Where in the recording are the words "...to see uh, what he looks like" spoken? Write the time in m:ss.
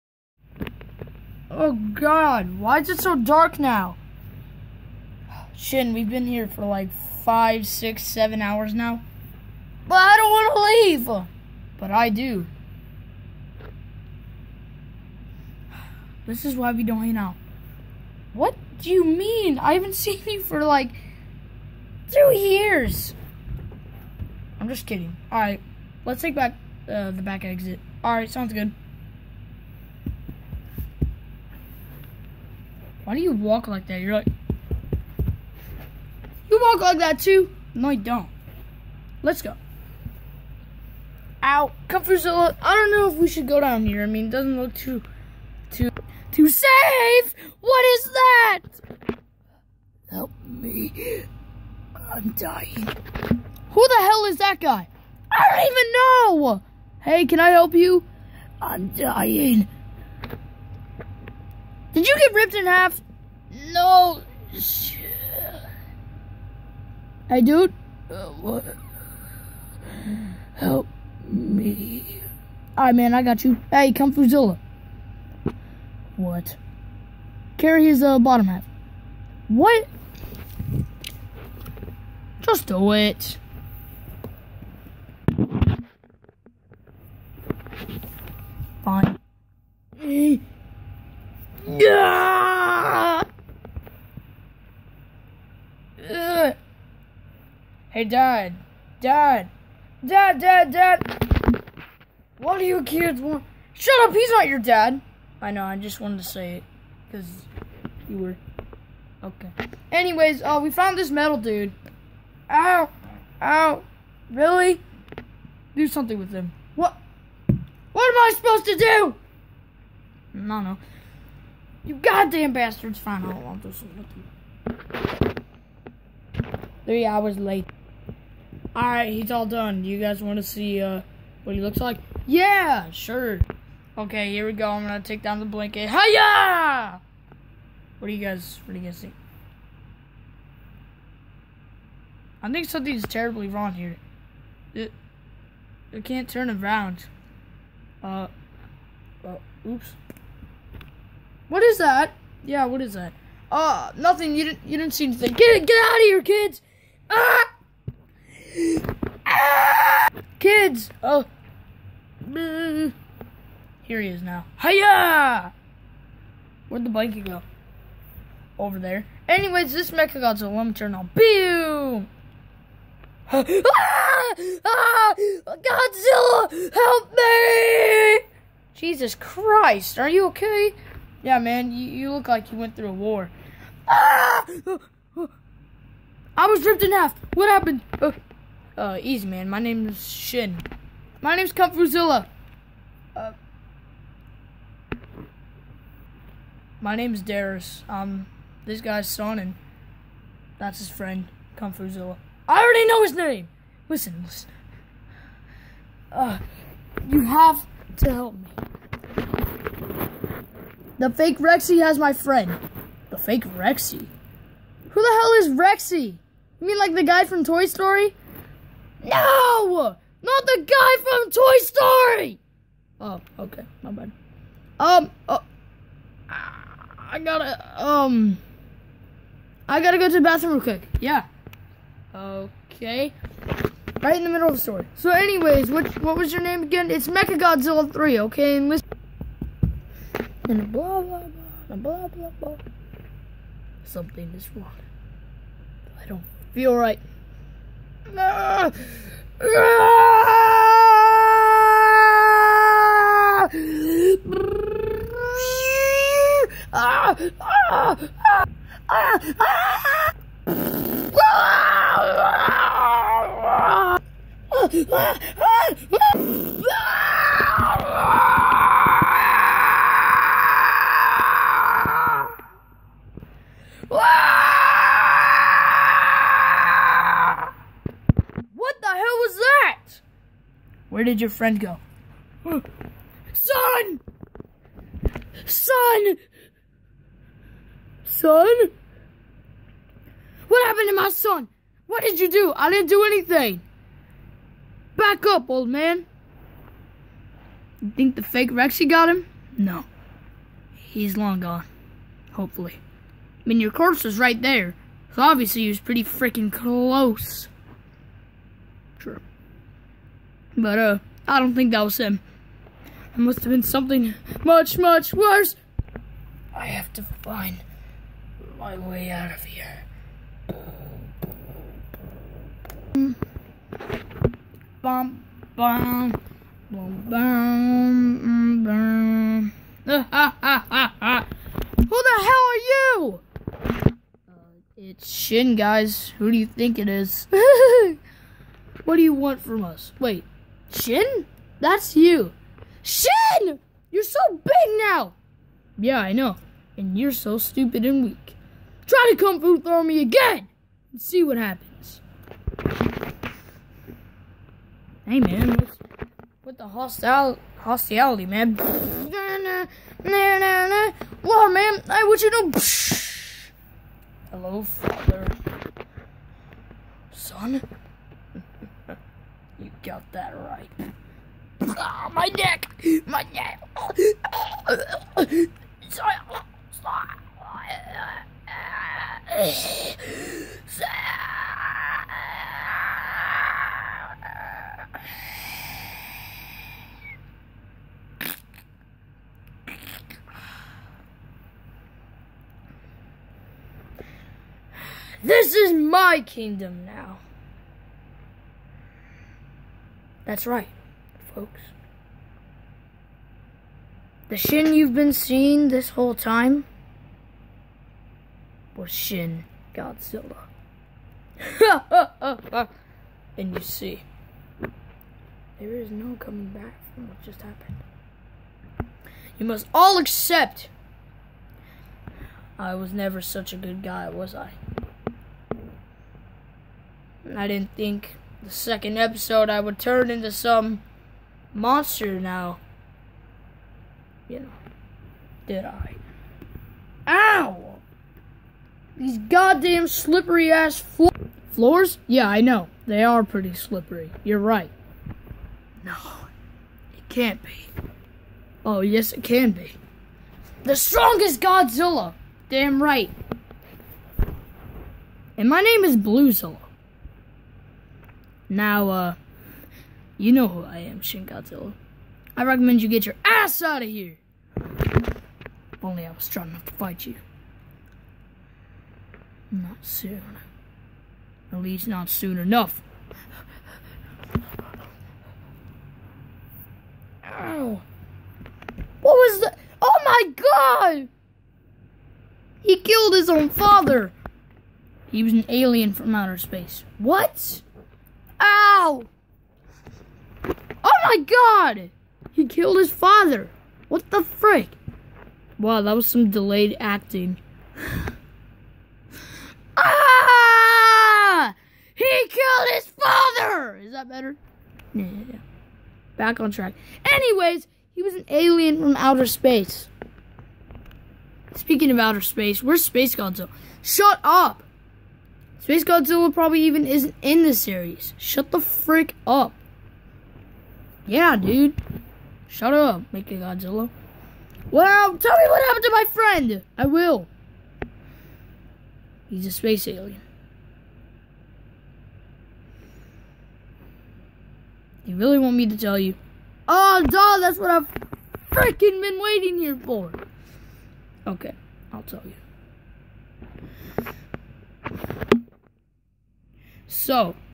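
2:10.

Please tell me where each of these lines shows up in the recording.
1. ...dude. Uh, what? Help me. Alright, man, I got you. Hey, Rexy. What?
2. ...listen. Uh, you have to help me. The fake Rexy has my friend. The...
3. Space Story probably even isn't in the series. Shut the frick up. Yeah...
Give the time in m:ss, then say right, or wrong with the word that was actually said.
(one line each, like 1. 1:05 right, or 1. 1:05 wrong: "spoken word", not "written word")
1. 1:07 wrong: "Comfortzilla", not "Rexy"
2. 3:24 right
3. 8:35 wrong: "Godzilla", not "Story".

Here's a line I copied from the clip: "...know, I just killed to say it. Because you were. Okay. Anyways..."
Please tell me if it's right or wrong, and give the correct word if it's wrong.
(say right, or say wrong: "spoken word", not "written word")
wrong: "wanted", not "killed".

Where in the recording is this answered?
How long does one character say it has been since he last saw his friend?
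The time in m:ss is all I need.
0:22.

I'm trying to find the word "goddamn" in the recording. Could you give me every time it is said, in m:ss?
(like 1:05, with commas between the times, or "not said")
2:01, 7:19.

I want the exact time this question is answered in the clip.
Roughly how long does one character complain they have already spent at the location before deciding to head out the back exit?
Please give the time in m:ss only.
0:07.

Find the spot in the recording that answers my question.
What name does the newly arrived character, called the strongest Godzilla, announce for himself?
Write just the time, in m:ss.
7:35.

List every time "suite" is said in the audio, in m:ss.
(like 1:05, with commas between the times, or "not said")
not said.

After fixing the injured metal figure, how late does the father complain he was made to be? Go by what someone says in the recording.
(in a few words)
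3 hours.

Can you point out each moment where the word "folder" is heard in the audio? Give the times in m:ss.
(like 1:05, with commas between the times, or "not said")
not said.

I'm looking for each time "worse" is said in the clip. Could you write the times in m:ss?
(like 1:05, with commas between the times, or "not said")
5:15.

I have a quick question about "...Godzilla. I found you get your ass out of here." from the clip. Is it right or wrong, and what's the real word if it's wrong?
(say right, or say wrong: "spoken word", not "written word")
wrong: "recommend", not "found".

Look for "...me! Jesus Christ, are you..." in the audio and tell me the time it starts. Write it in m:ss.
2:57.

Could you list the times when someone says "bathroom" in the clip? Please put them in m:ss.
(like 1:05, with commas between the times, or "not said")
3:50.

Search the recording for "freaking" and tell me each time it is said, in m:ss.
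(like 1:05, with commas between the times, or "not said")
5:06, 8:58.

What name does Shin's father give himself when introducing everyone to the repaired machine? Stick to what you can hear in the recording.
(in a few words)
Darius.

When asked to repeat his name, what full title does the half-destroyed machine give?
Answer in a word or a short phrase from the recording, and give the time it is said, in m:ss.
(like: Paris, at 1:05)
Mechagodzilla 3, at 3:57.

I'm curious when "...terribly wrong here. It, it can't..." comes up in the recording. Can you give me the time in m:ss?
2:23.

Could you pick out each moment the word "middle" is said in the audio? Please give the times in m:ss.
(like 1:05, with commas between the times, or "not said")
3:54.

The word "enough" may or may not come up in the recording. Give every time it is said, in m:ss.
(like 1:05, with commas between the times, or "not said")
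7:46, 7:52.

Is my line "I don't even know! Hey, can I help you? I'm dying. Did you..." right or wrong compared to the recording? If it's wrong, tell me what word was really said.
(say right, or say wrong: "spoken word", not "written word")
right.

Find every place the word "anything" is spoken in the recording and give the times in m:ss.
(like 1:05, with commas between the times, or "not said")
2:35, 4:53.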